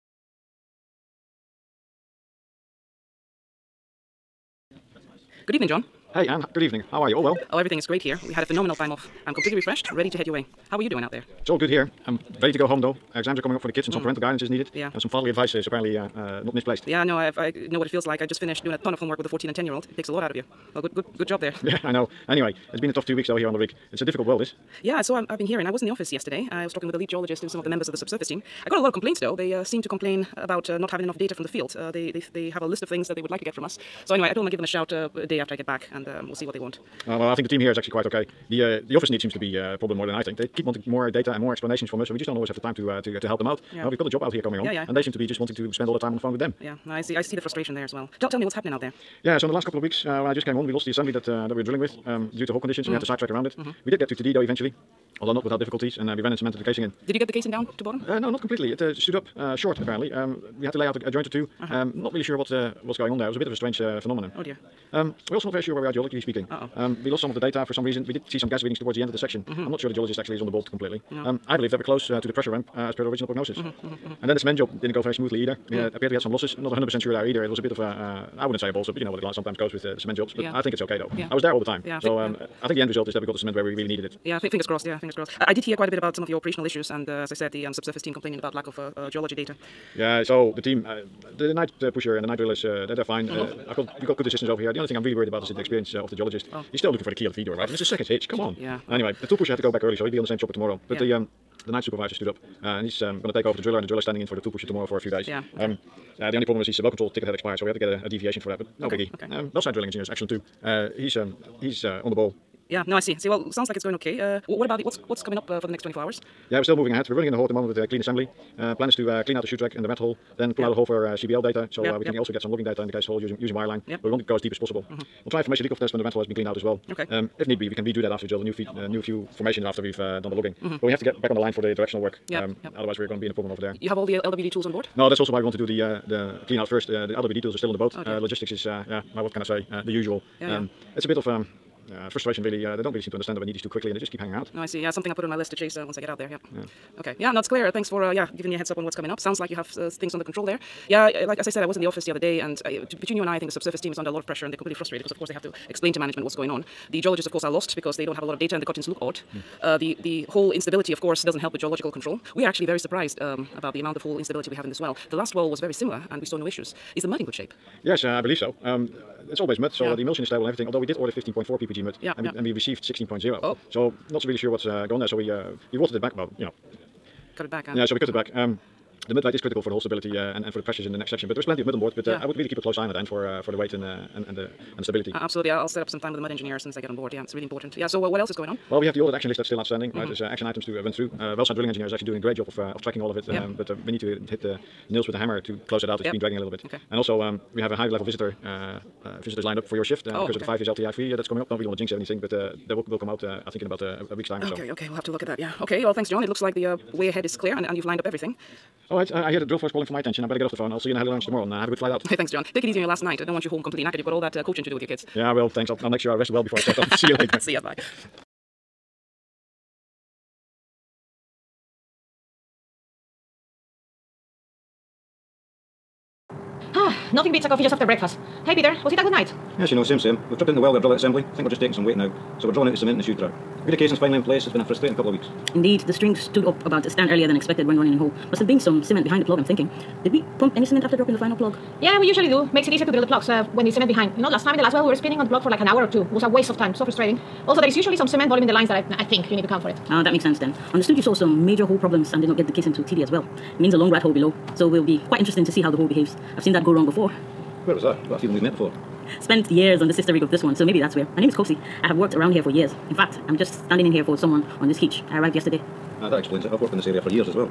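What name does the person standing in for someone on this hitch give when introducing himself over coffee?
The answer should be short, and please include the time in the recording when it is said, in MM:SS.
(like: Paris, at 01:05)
Kosi, at 04:21.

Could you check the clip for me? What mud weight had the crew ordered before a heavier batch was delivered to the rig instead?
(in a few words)
15.4 ppg.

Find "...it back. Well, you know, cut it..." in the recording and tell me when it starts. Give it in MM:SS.
02:55.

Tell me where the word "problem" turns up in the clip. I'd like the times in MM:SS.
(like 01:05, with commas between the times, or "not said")
00:39, 01:46, 02:13, 04:11.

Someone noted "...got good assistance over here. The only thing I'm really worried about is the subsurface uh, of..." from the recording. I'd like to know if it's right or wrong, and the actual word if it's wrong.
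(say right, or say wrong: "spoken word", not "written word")
wrong: "experience", not "subsurface".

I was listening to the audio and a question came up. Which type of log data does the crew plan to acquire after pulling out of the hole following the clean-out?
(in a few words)
CBL.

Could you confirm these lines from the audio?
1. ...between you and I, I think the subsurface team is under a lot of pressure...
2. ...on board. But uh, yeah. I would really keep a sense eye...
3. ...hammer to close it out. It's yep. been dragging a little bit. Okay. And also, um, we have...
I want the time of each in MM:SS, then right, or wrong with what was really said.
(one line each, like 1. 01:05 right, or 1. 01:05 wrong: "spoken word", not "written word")
1. 02:33 right
2. 03:01 wrong: "close", not "sense"
3. 03:15 right.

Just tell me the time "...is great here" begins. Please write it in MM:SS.
00:07.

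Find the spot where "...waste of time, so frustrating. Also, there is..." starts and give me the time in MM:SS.
04:06.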